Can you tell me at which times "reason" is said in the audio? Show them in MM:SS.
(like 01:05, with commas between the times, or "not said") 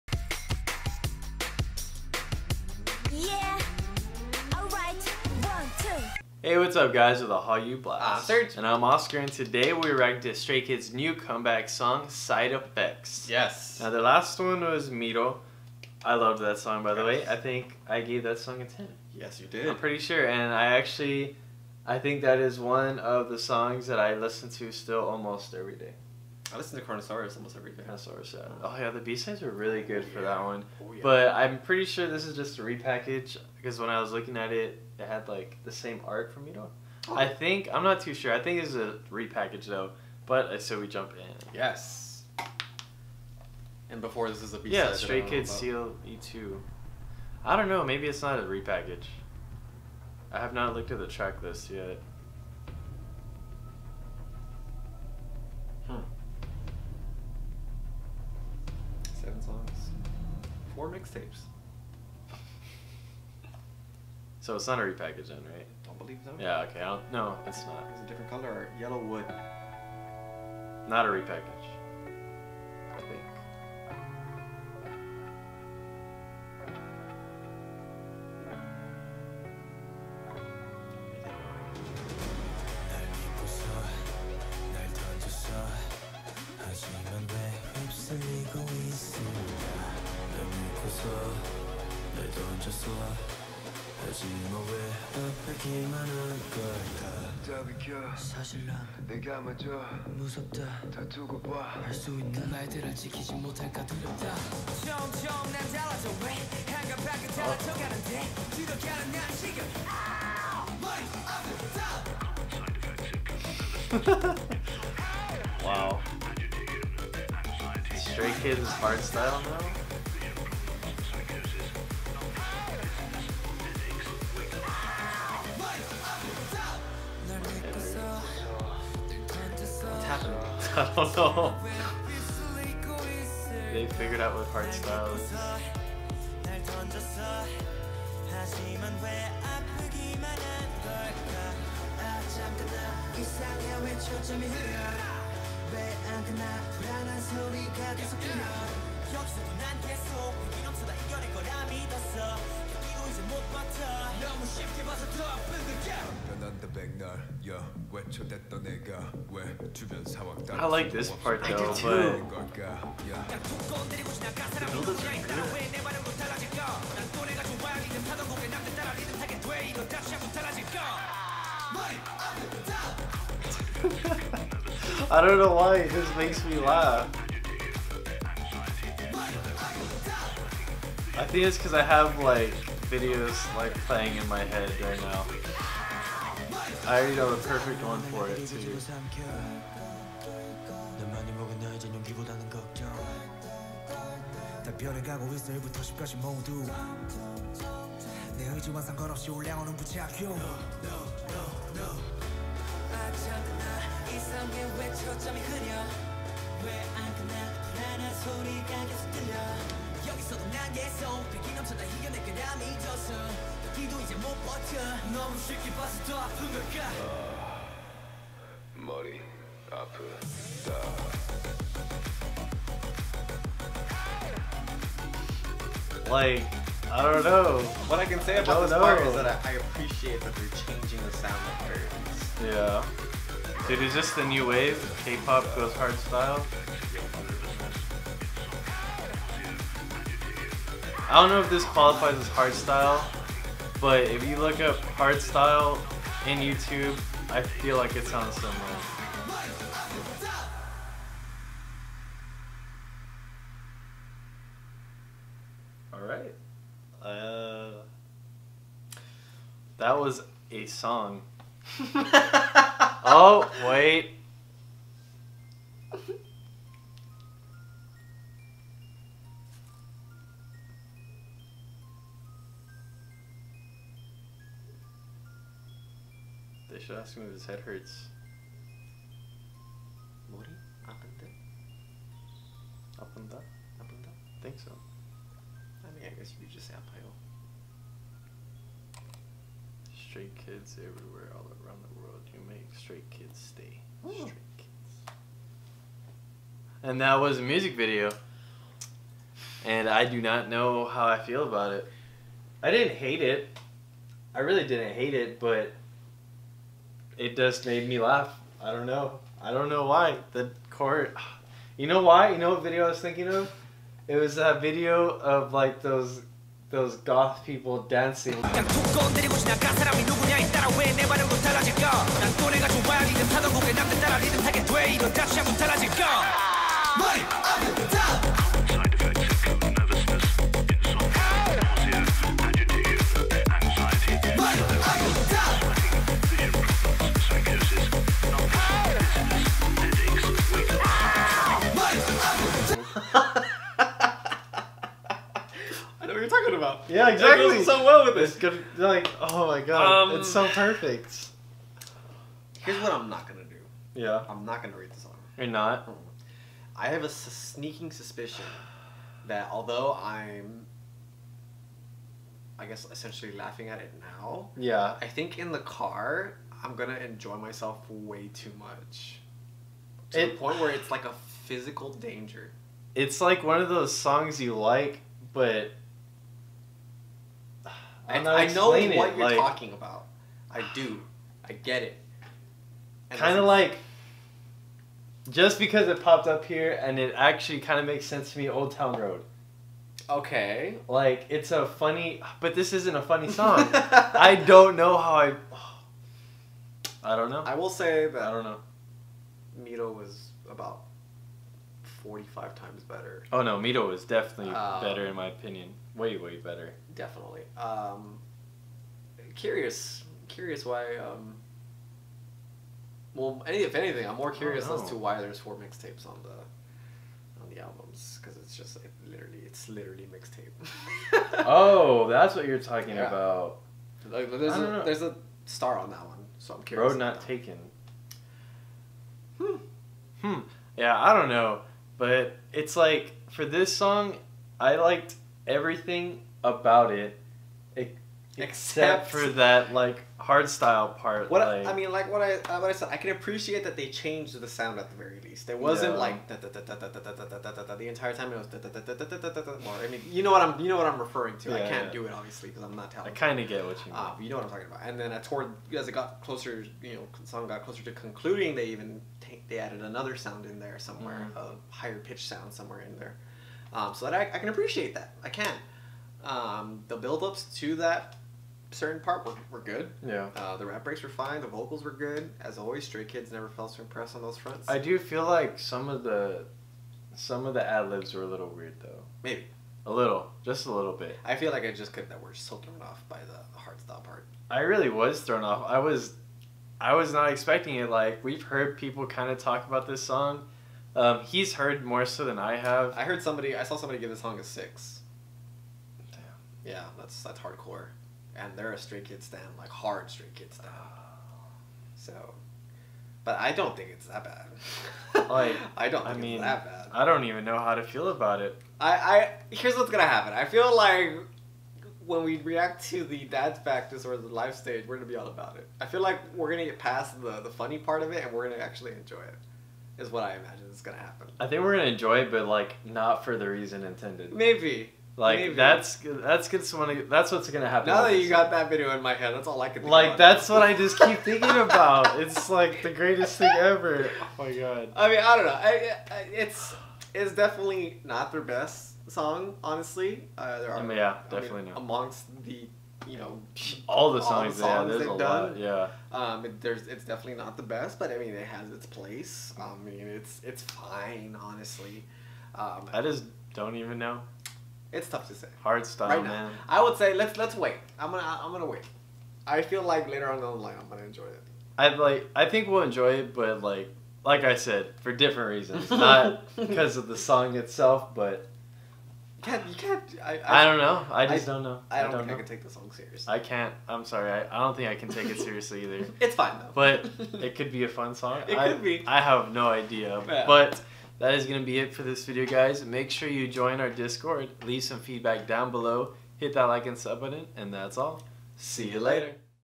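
08:43, 09:25.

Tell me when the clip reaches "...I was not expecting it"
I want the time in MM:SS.
08:06.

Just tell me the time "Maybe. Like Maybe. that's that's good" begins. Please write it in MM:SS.
08:44.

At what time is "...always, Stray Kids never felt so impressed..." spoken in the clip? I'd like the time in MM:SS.
07:52.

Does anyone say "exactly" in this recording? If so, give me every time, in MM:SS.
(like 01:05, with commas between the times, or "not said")
05:47.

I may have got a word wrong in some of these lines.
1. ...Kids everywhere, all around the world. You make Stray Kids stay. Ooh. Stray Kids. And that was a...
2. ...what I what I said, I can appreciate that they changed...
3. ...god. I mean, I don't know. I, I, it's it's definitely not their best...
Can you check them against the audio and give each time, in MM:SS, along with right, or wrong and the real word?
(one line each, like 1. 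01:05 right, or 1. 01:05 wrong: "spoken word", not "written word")
1. 04:50 right
2. 07:22 right
3. 08:54 right.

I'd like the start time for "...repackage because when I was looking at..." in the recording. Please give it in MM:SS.
00:32.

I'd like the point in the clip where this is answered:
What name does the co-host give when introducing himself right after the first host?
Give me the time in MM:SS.
00:08.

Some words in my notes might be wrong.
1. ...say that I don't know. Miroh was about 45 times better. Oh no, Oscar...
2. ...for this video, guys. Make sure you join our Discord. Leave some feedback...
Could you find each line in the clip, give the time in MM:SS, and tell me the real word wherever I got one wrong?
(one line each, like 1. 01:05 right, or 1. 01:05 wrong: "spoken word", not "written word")
1. 06:37 wrong: "Miroh", not "Oscar"
2. 09:41 right.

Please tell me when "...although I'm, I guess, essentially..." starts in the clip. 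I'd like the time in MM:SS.
05:59.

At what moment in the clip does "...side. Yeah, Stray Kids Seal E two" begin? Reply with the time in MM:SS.
00:44.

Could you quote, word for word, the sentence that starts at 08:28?
I I here's what's gonna happen.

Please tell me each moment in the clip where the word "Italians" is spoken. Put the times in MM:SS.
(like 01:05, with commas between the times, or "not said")
not said.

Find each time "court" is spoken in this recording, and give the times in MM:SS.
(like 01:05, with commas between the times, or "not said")
05:10.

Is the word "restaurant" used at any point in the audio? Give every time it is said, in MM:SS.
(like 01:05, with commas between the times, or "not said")
not said.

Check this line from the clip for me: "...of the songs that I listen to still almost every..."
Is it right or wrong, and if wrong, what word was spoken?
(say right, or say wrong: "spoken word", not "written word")
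right.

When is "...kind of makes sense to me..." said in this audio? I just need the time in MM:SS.
06:27.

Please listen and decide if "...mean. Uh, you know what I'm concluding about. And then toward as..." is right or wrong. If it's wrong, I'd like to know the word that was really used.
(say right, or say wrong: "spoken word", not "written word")
wrong: "talking", not "concluding".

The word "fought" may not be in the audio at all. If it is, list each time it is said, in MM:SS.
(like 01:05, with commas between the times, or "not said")
not said.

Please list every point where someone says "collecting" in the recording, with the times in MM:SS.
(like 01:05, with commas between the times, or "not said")
not said.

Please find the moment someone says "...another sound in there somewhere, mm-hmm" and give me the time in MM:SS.
07:39.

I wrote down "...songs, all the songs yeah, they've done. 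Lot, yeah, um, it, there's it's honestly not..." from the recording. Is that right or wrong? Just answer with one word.
wrong.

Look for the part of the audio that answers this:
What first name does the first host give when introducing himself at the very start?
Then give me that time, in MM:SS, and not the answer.
00:08.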